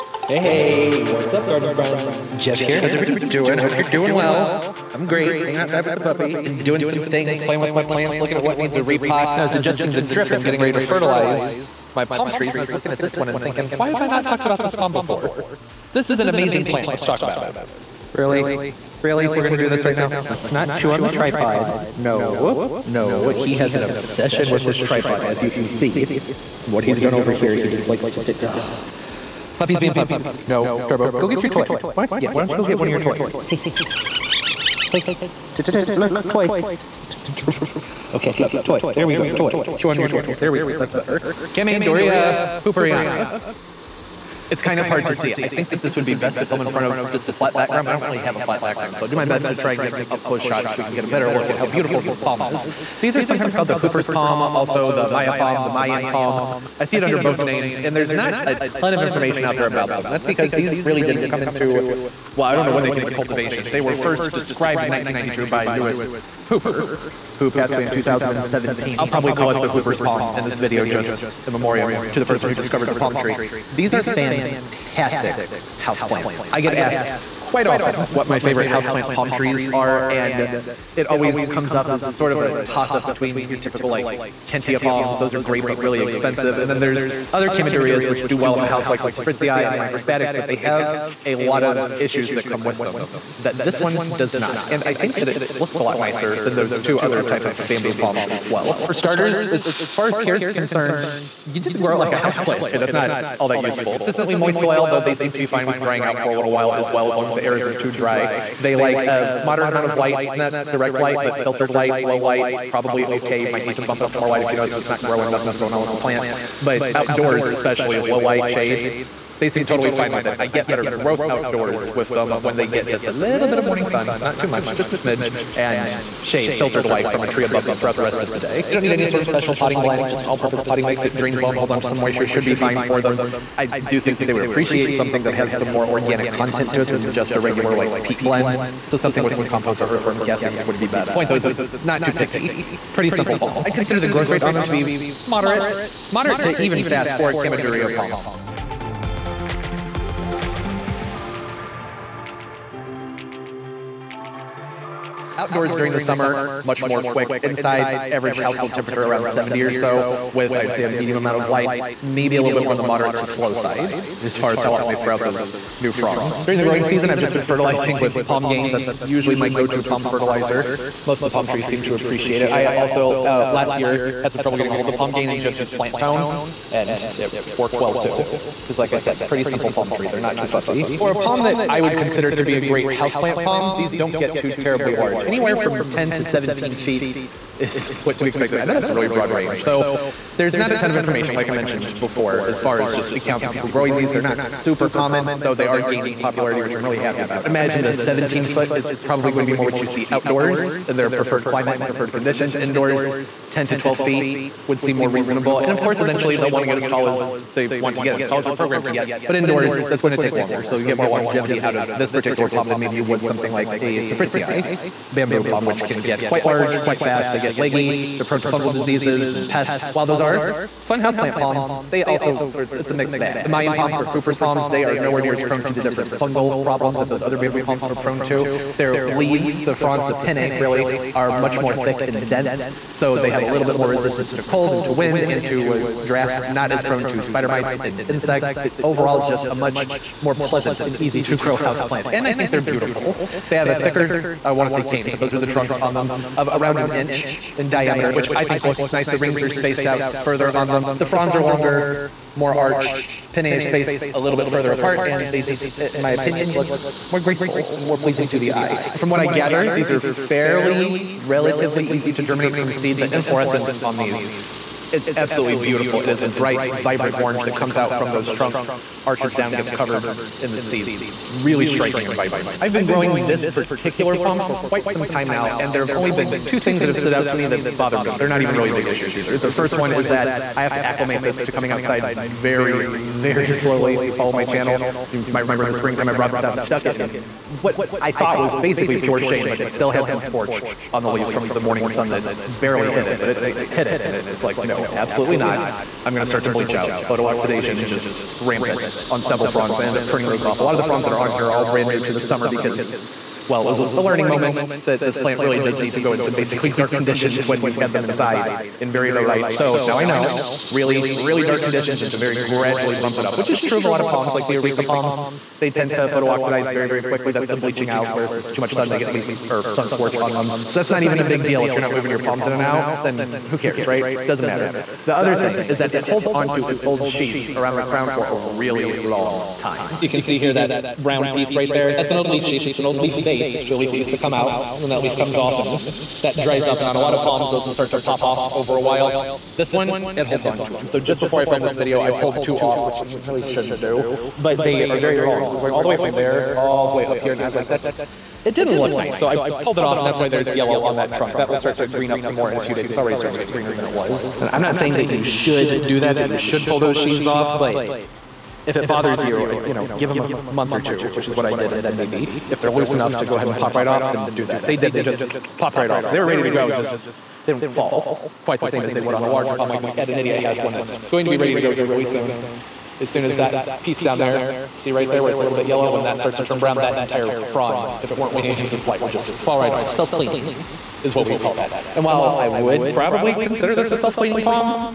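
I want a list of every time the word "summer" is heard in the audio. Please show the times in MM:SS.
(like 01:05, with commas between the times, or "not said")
02:36, 05:02.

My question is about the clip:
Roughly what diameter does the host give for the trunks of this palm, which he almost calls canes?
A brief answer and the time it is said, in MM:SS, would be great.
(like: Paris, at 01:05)
An inch, at 04:06.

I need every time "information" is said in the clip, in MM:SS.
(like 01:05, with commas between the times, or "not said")
00:59, 03:10.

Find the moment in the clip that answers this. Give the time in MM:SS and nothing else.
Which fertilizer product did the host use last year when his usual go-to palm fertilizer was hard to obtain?
02:55.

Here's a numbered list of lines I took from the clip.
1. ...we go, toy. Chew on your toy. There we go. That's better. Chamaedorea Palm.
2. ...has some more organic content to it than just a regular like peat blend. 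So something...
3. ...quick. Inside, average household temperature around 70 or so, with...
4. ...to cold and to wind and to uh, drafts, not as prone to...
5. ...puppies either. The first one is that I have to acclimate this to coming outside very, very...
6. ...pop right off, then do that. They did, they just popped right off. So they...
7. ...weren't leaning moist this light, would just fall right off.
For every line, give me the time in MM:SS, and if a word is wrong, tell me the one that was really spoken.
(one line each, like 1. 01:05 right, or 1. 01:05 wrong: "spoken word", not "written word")
1. 00:39 wrong: "Hooperiana", not "Palm"
2. 02:15 right
3. 02:37 right
4. 03:54 right
5. 04:38 wrong: "issues", not "puppies"
6. 06:03 right
7. 06:18 wrong: "against", not "moist".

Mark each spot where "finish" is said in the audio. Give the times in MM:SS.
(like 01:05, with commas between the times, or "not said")
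not said.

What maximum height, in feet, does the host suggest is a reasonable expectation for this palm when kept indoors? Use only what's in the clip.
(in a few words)
12 feet.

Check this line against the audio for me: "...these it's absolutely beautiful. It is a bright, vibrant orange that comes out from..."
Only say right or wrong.
right.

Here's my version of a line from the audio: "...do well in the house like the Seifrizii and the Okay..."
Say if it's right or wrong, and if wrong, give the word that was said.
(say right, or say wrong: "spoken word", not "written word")
wrong: "Microspadix", not "Okay".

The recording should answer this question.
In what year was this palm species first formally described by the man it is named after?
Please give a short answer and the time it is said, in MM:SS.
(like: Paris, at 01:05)
1992, at 01:04.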